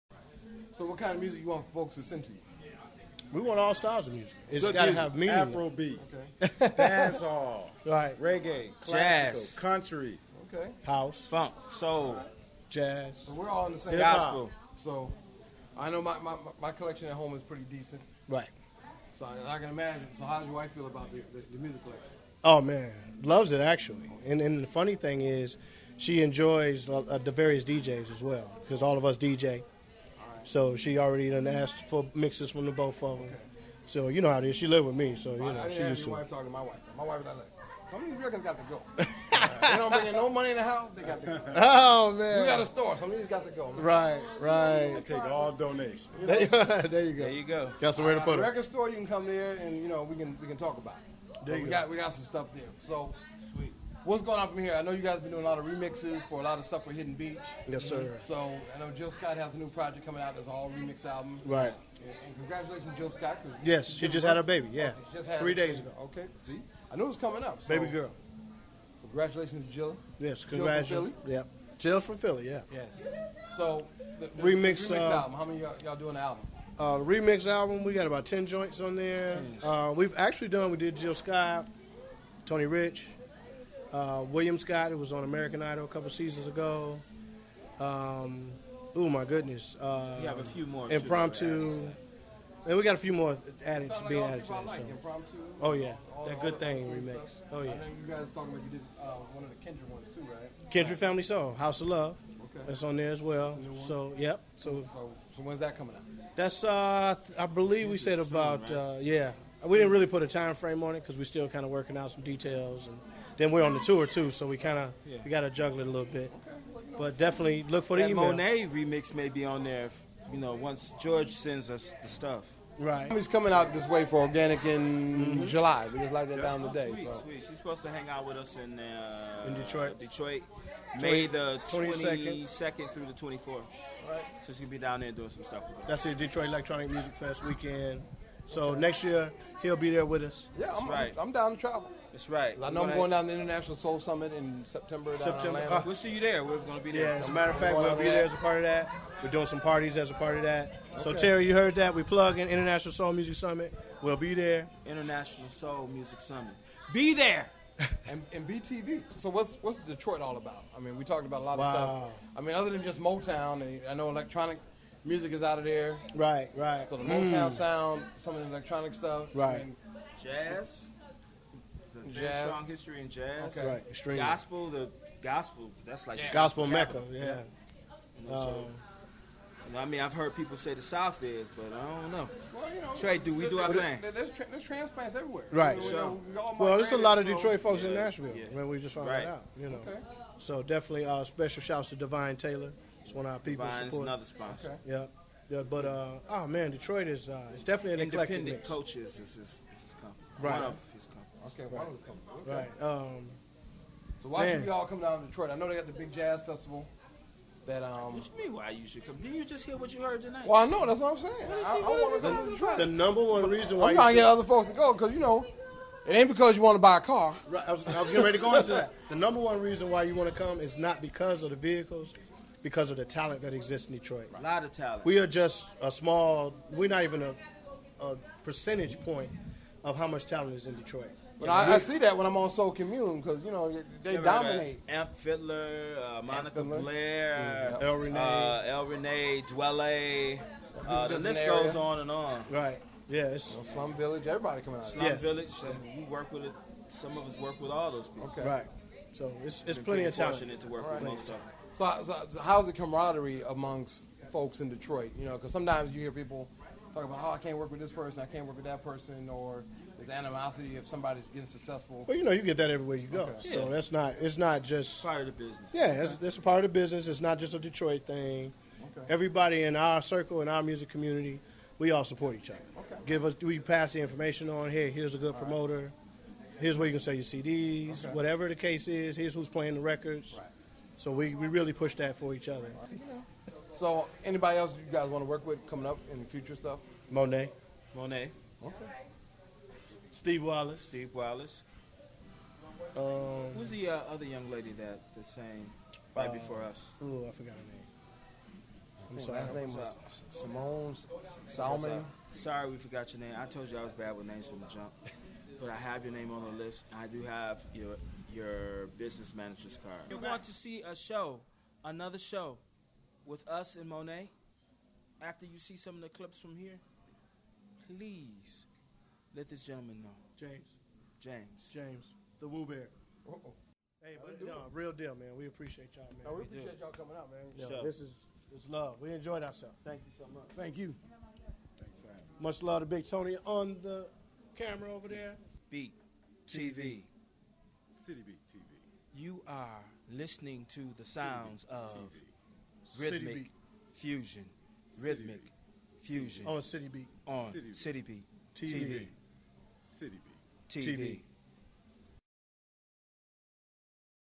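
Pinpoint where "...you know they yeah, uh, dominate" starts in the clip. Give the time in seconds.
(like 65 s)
233 s.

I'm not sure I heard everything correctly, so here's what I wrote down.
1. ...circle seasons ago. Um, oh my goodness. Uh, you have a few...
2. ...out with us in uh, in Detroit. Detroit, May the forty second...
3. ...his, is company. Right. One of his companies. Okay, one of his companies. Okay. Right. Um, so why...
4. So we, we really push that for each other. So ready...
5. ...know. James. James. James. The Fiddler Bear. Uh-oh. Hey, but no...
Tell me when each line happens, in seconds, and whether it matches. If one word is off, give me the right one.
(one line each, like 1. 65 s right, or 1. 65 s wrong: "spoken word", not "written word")
1. 85 s wrong: "couple", not "circle"
2. 128 s wrong: "twenty", not "forty"
3. 199 s right
4. 281 s wrong: "anybody", not "ready"
5. 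320 s wrong: "Woo", not "Fiddler".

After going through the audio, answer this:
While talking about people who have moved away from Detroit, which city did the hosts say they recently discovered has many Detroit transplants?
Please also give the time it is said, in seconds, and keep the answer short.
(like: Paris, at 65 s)
Nashville, at 187 s.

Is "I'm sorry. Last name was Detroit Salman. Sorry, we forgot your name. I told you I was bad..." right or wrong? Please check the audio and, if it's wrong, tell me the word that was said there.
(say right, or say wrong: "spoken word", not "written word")
wrong: "Simone", not "Detroit".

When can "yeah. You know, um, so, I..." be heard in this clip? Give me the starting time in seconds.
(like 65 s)
177 s.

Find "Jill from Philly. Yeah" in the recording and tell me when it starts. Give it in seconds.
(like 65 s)
71 s.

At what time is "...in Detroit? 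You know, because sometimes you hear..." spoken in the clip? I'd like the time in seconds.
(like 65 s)
254 s.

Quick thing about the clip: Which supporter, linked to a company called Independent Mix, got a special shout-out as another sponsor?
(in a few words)
Divine Taylor.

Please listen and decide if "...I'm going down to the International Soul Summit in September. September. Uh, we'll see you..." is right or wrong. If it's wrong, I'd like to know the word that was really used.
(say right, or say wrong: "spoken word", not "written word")
right.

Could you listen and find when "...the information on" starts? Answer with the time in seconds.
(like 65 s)
273 s.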